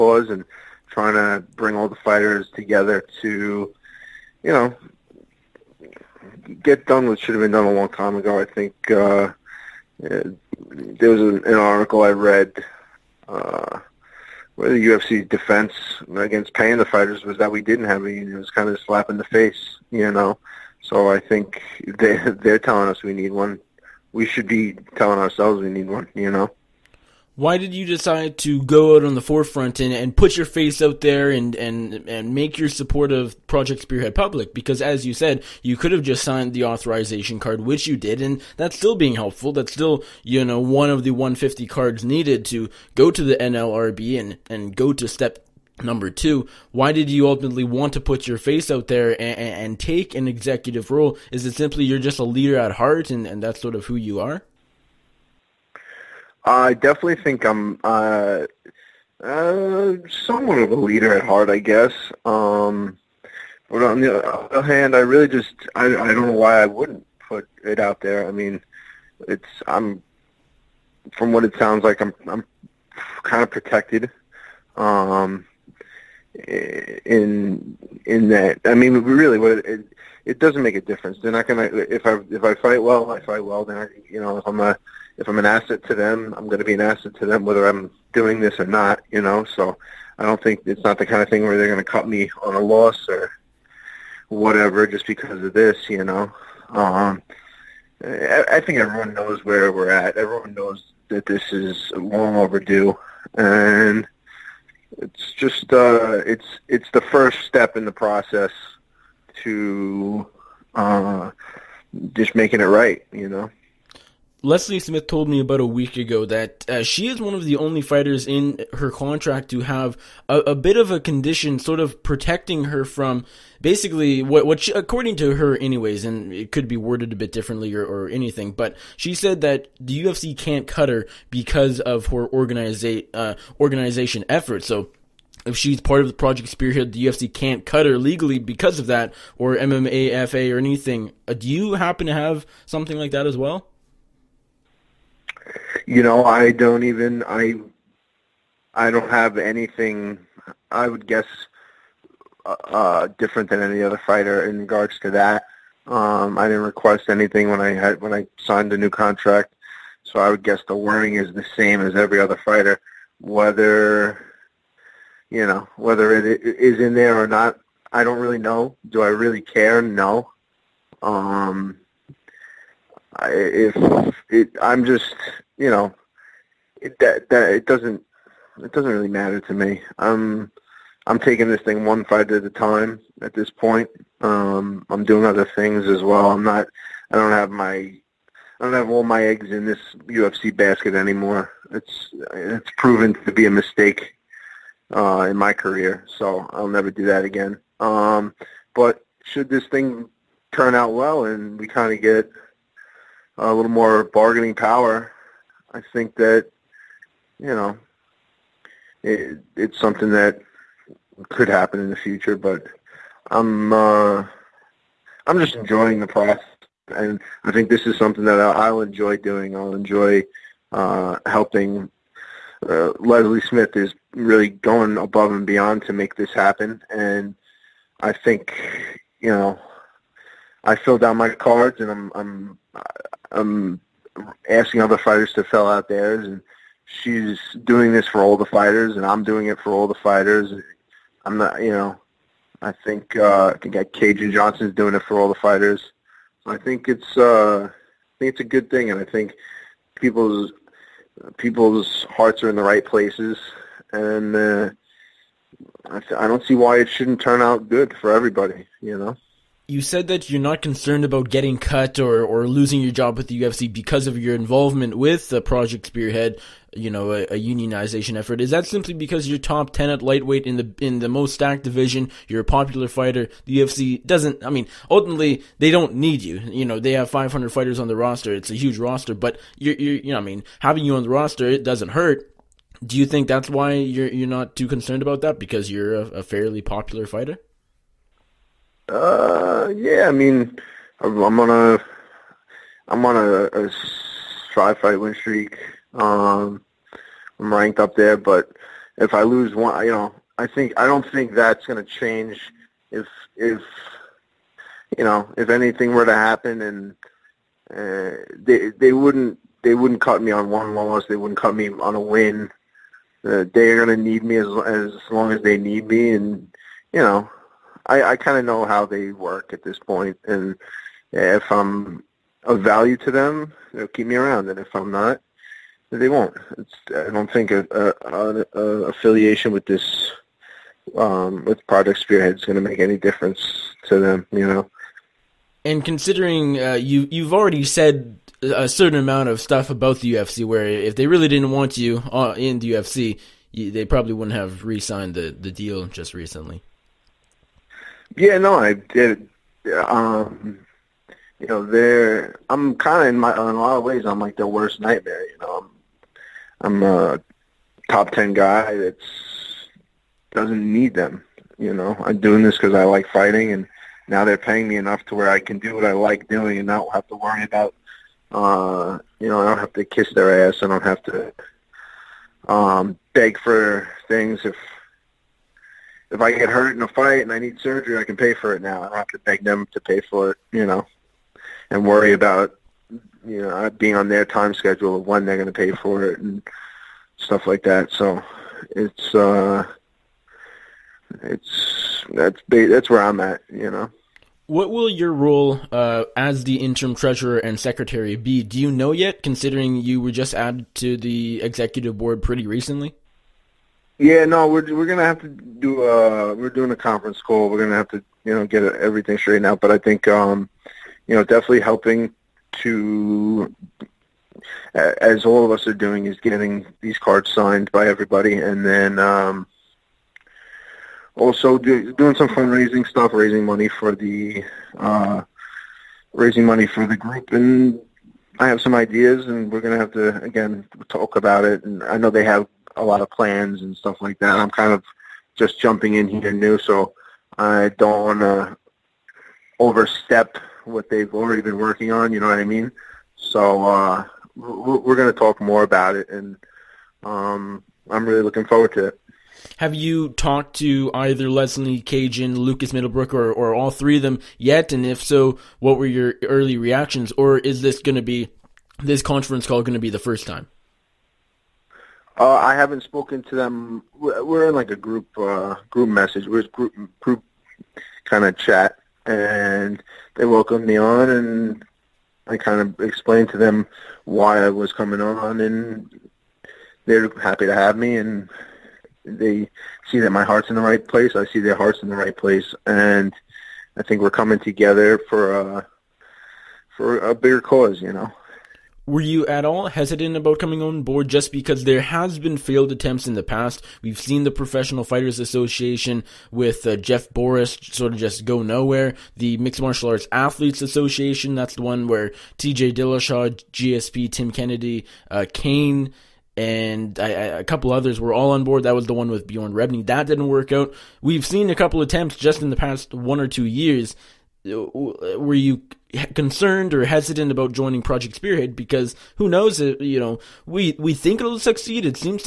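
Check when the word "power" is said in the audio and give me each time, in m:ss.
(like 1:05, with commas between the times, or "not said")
3:24.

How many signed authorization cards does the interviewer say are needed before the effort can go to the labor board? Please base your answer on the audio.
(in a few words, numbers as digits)
150.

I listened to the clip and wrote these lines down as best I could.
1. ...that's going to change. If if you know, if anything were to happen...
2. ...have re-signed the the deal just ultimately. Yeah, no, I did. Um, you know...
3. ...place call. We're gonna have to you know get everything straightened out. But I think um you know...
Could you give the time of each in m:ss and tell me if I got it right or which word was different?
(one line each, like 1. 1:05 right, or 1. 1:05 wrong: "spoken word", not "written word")
1. 5:01 right
2. 5:44 wrong: "recently", not "ultimately"
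3. 6:46 wrong: "conference", not "place".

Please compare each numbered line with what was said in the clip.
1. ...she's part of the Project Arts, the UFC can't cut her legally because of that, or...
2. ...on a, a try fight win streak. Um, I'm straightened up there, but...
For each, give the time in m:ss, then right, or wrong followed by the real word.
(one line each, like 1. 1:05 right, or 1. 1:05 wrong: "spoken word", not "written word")
1. 2:15 wrong: "Spearhead", not "Arts"
2. 4:53 wrong: "ranked", not "straightened".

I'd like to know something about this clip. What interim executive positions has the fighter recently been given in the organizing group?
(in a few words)
Treasurer and secretary.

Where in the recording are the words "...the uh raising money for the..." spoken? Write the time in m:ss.
7:03.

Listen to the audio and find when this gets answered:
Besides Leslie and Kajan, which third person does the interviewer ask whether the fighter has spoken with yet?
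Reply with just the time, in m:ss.
7:32.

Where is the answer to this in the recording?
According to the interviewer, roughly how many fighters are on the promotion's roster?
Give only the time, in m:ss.
4:37.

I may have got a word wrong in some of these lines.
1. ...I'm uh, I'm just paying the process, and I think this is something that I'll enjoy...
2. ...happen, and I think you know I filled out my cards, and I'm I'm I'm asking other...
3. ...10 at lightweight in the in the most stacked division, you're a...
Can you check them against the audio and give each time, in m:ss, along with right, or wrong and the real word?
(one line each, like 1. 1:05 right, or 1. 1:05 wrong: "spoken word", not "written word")
1. 3:33 wrong: "enjoying", not "paying"
2. 3:46 right
3. 4:29 right.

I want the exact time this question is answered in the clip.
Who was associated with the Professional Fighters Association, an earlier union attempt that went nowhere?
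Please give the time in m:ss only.
8:16.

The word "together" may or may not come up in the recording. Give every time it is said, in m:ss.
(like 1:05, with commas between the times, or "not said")
0:02, 8:04.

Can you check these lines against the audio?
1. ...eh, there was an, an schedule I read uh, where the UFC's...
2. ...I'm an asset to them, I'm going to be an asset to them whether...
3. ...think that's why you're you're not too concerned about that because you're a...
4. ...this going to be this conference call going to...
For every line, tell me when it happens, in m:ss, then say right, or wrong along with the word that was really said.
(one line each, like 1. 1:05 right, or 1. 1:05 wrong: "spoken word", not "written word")
1. 0:10 wrong: "article", not "schedule"
2. 1:25 right
3. 4:43 right
4. 7:37 right.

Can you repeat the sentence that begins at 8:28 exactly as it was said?
That was the one with Bjorn Rebney.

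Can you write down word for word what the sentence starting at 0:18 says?
It was kind of a slap in the face, you know.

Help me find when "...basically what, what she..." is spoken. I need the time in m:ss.
2:03.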